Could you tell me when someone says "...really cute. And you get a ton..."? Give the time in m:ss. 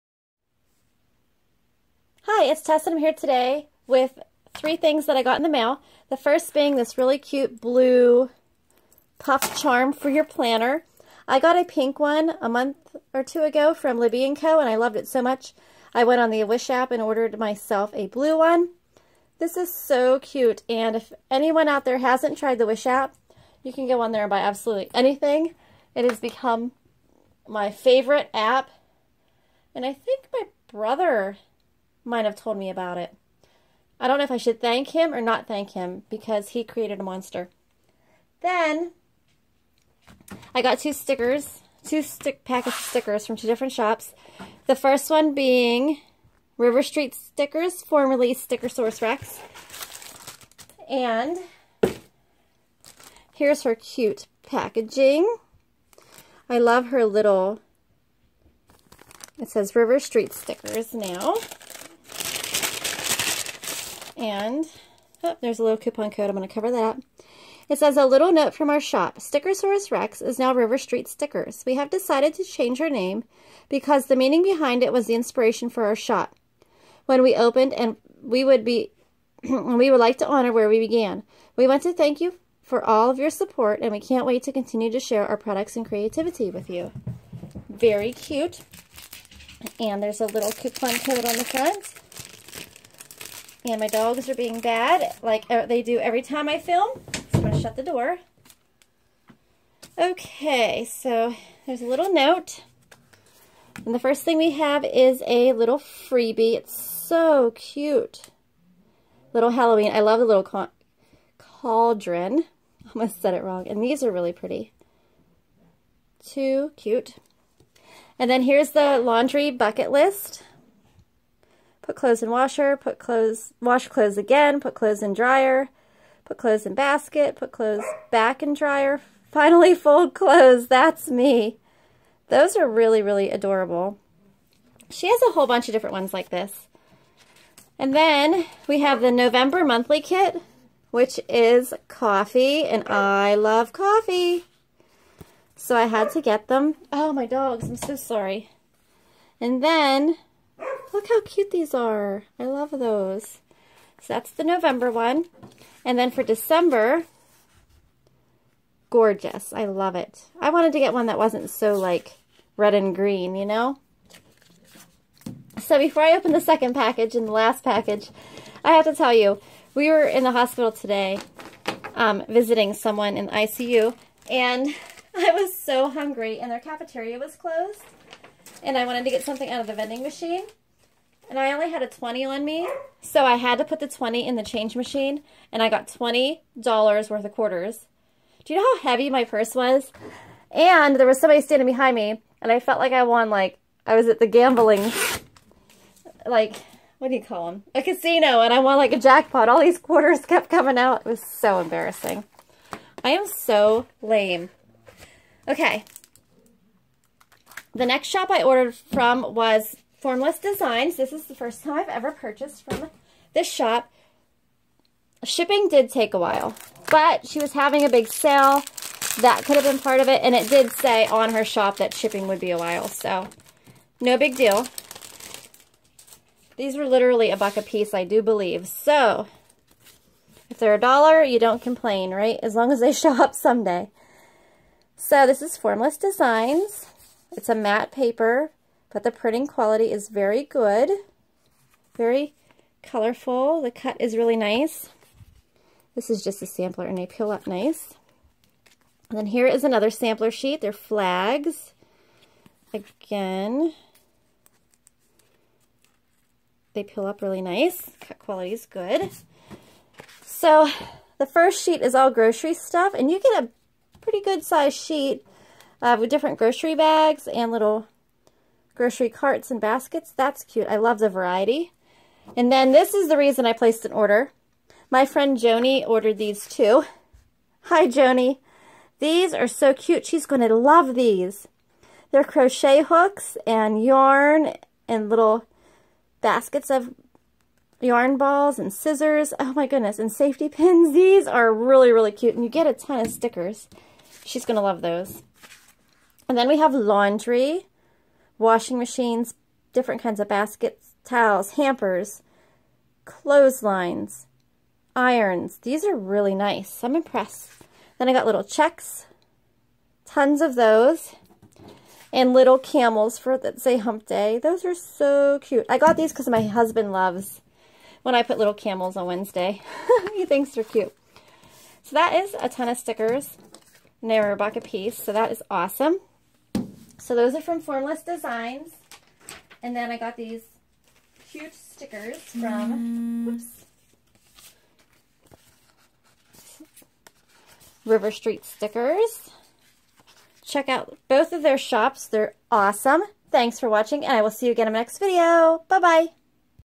4:51.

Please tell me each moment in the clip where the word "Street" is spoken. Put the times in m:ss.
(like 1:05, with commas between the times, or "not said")
0:46, 0:59, 1:10, 5:38.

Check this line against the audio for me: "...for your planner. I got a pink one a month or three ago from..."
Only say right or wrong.
wrong.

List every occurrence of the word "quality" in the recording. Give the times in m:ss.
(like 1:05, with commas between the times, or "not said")
3:59, 4:18.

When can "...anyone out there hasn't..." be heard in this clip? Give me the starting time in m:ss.
0:21.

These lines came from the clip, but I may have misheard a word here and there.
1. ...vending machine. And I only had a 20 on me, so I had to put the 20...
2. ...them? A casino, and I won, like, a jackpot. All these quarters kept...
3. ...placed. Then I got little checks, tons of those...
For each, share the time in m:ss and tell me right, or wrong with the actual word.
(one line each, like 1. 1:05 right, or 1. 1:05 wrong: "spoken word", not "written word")
1. 2:59 right
2. 3:17 right
3. 5:06 wrong: "impressed", not "placed".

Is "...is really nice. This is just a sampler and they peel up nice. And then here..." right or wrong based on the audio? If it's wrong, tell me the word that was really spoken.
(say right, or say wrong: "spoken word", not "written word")
right.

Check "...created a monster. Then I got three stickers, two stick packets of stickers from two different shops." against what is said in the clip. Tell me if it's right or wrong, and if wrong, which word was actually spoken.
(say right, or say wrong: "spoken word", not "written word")
wrong: "two", not "three".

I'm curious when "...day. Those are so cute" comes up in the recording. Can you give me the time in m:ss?
5:14.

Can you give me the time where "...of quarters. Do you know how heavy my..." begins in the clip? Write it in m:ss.
3:07.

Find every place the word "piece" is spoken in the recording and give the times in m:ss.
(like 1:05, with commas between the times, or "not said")
3:47, 5:24.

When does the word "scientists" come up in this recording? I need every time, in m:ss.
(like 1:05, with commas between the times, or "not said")
not said.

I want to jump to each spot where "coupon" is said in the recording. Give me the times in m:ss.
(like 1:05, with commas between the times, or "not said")
1:05, 1:30.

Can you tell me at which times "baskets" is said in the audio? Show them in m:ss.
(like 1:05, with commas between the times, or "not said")
2:06, 4:29, 4:46, 5:00.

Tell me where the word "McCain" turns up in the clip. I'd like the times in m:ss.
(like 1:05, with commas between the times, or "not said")
not said.